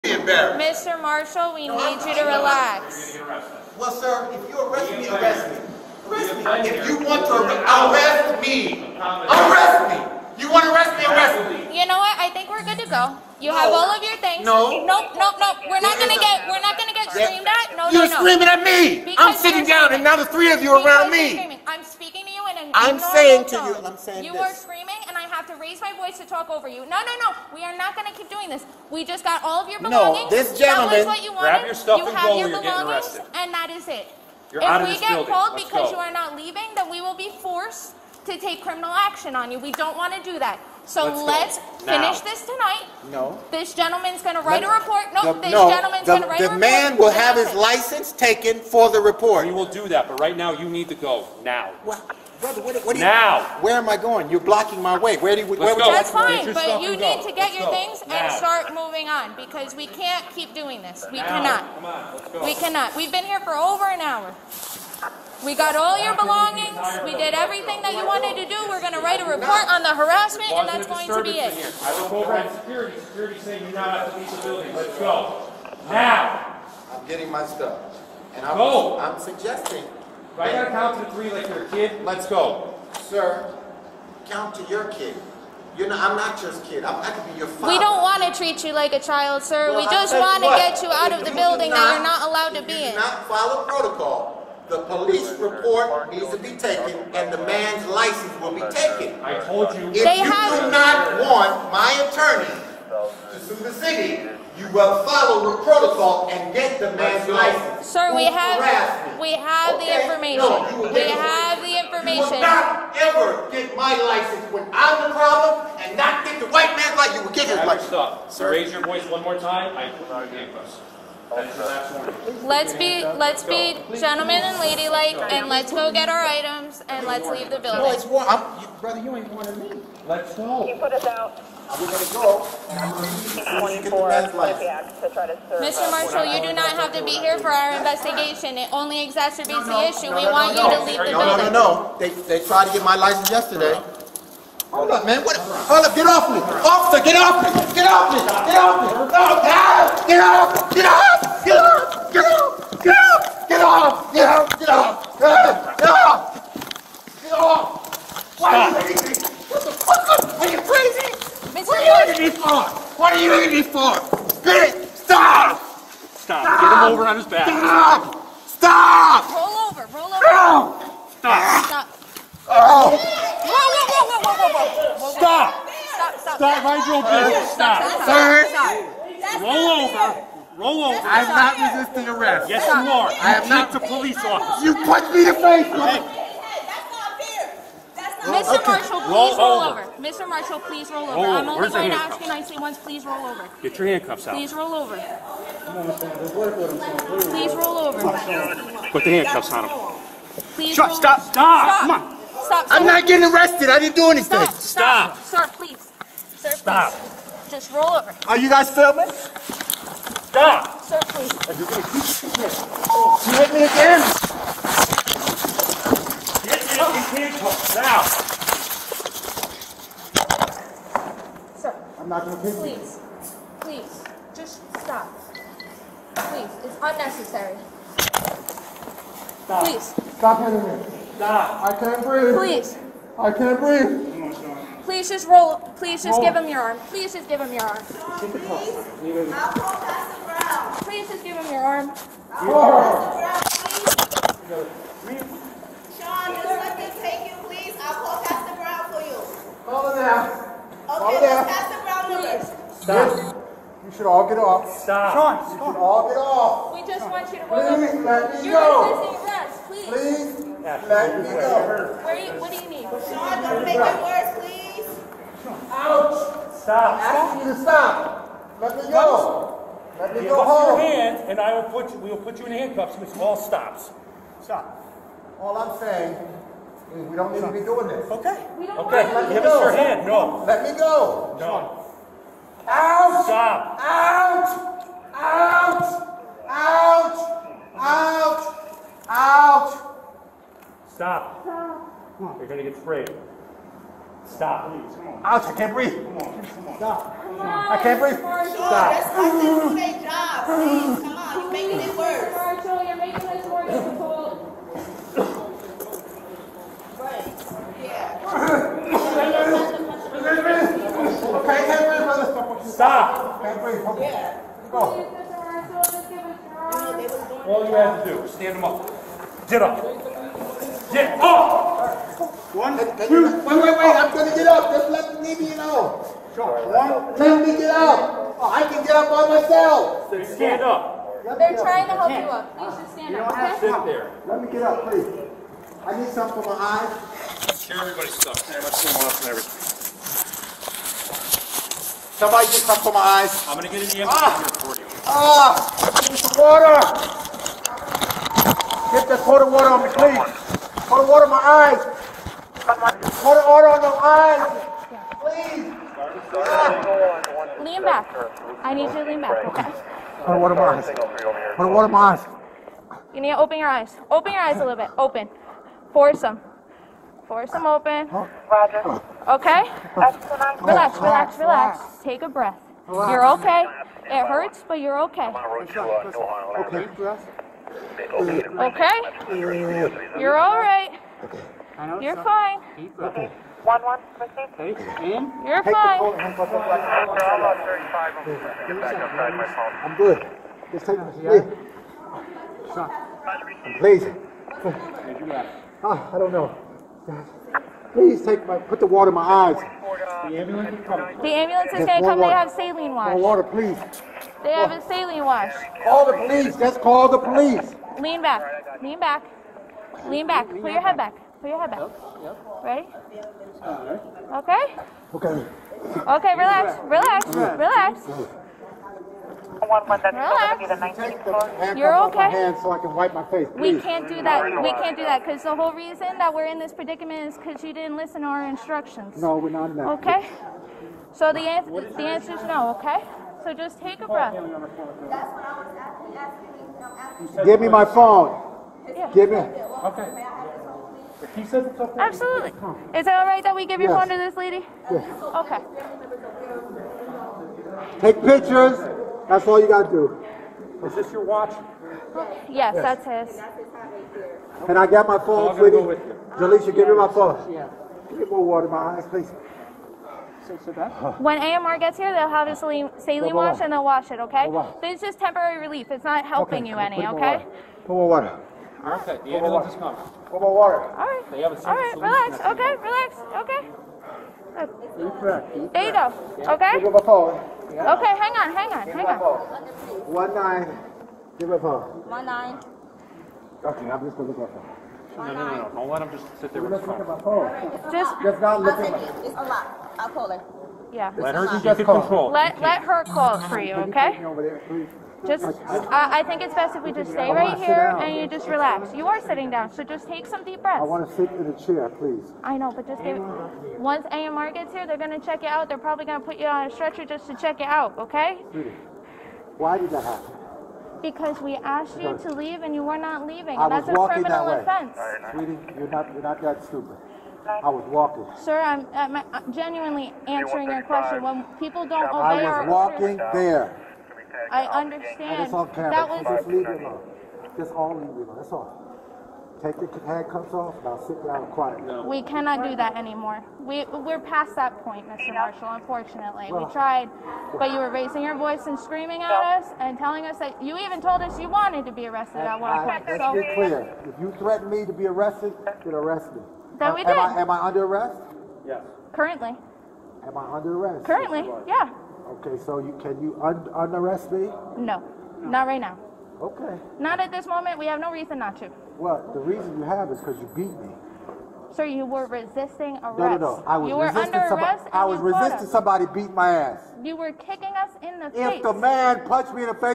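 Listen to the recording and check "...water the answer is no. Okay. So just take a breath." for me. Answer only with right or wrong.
wrong.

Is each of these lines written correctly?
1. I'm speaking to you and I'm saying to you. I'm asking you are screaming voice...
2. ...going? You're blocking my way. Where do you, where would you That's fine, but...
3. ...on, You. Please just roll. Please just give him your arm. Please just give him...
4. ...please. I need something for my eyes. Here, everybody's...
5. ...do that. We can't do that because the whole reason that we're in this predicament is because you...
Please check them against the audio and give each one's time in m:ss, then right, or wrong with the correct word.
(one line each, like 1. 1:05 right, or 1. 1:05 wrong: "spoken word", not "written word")
1. 0:21 wrong: "saying", not "asking"
2. 0:53 right
3. 3:54 wrong: "Sean", not "You"
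4. 5:34 right
5. 7:04 right.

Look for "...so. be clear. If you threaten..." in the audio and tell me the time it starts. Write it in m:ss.
9:03.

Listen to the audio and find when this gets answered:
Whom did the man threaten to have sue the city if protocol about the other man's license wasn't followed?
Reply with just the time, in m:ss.
1:41.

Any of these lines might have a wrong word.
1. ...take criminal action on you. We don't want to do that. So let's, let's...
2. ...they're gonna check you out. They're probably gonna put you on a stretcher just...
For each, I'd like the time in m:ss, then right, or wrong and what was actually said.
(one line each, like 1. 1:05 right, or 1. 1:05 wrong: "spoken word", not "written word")
1. 0:38 right
2. 8:24 right.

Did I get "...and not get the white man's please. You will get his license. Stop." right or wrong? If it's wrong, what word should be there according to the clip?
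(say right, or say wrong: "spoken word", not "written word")
wrong: "license", not "please".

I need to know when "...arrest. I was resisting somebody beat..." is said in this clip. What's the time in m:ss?
9:24.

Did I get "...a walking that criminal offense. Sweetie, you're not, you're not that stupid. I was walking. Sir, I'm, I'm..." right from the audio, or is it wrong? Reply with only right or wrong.
right.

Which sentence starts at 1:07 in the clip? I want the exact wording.
We did everything that you wanted to do.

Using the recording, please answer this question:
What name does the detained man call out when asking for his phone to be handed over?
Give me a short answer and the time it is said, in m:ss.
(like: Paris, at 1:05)
Jaleesha, at 7:36.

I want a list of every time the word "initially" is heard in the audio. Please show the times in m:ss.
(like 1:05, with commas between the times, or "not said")
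not said.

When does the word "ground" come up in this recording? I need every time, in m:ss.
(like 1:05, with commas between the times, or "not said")
4:00, 4:04.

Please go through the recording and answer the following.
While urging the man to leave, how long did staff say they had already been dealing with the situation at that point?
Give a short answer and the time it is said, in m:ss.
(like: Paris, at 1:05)
over an hour, at 1:03.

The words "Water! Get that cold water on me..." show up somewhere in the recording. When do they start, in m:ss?
5:46.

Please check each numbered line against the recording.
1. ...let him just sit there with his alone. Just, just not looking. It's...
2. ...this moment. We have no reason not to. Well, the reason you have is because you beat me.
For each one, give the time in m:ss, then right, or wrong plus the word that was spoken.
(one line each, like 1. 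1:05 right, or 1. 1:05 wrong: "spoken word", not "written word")
1. 8:05 wrong: "phone", not "alone"
2. 9:17 right.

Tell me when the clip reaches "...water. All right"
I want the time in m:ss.
7:50.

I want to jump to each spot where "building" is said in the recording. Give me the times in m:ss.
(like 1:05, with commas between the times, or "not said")
0:35, 1:14, 1:31, 2:07.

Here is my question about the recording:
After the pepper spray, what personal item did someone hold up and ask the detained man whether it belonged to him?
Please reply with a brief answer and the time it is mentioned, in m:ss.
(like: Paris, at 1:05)
watch, at 7:31.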